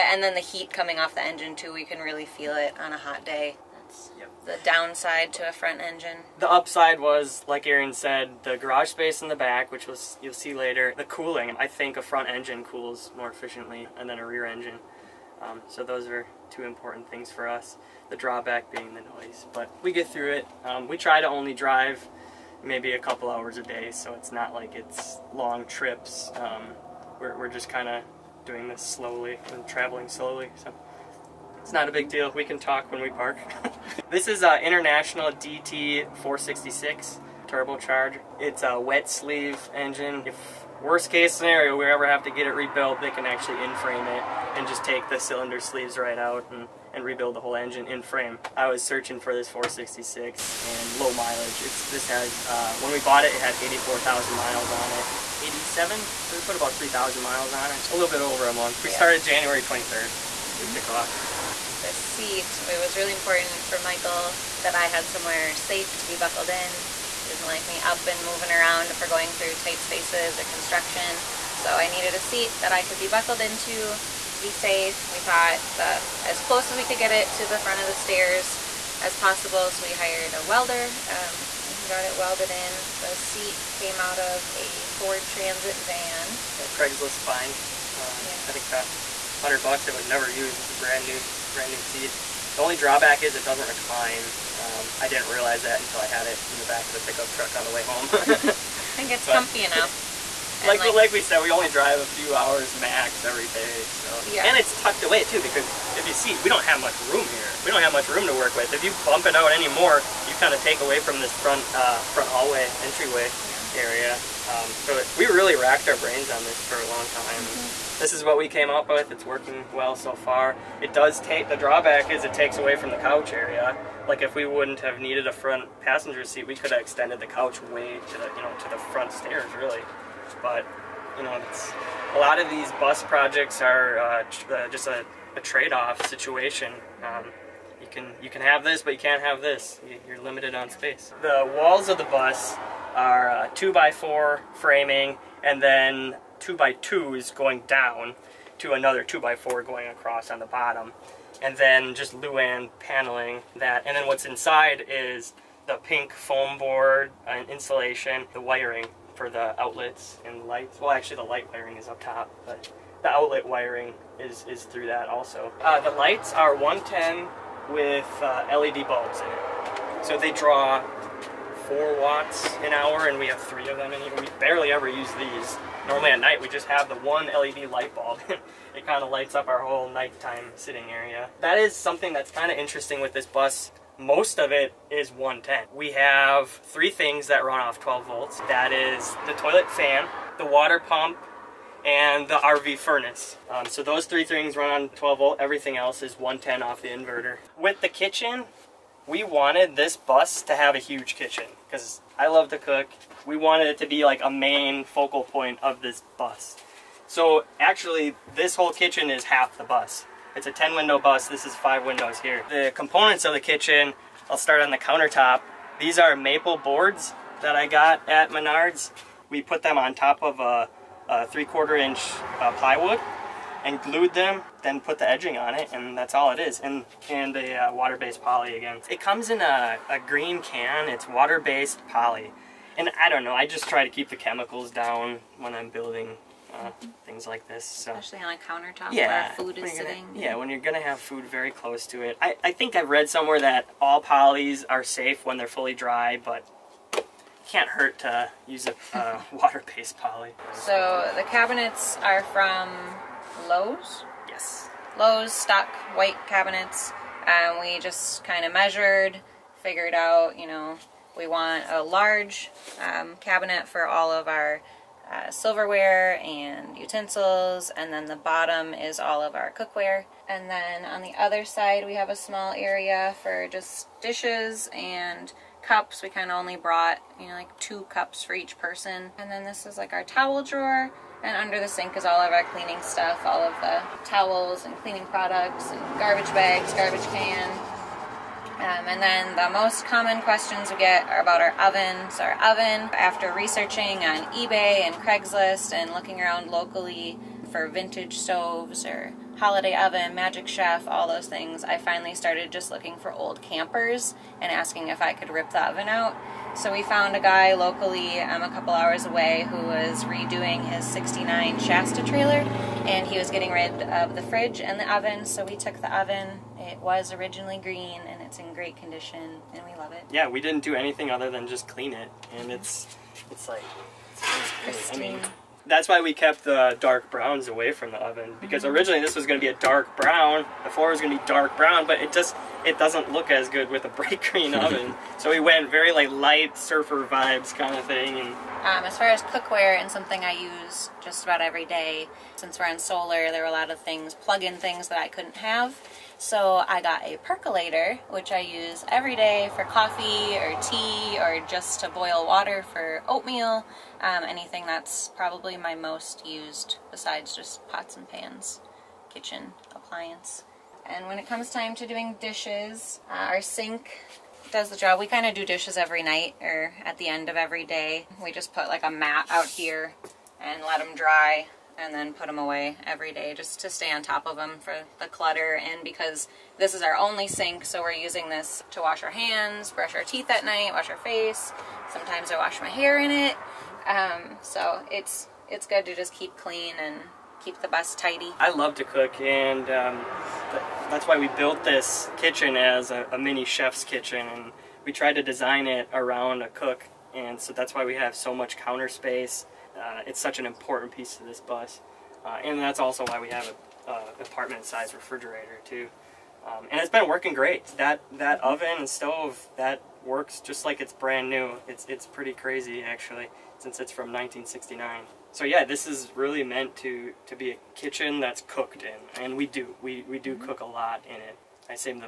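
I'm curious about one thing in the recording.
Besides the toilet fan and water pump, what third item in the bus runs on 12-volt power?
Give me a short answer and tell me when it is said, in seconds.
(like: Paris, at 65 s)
RV furnace, at 192 s.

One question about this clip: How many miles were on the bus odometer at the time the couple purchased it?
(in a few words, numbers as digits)
84,000.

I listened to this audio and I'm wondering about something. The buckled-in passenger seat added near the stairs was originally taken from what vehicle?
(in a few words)
Ford Transit van.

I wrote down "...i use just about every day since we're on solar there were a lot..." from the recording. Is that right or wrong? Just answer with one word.
right.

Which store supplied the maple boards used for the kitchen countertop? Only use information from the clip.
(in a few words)
Menards.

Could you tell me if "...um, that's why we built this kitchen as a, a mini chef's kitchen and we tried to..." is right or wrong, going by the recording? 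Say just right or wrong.
right.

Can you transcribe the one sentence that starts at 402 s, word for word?
Uh, and that's also why we have a, a apartment-sized refrigerator too.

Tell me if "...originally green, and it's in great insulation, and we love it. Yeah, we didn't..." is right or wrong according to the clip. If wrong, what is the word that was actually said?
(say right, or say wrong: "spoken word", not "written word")
wrong: "condition", not "insulation".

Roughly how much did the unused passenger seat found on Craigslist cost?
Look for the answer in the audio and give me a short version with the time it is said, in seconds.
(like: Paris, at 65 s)
$100, at 89 s.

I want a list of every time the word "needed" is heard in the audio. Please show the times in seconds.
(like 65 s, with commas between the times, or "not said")
71 s, 125 s.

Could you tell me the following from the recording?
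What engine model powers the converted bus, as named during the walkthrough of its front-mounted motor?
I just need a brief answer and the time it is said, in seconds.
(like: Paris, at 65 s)
International DT466, at 34 s.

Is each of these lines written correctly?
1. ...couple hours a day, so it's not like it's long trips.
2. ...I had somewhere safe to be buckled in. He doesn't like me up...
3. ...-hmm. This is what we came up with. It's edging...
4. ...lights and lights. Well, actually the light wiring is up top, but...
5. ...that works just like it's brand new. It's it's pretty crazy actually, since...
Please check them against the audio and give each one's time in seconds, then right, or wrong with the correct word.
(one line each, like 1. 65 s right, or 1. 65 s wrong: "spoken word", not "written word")
1. 22 s right
2. 64 s right
3. 117 s wrong: "working", not "edging"
4. 159 s wrong: "outlets", not "lights"
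5. 409 s right.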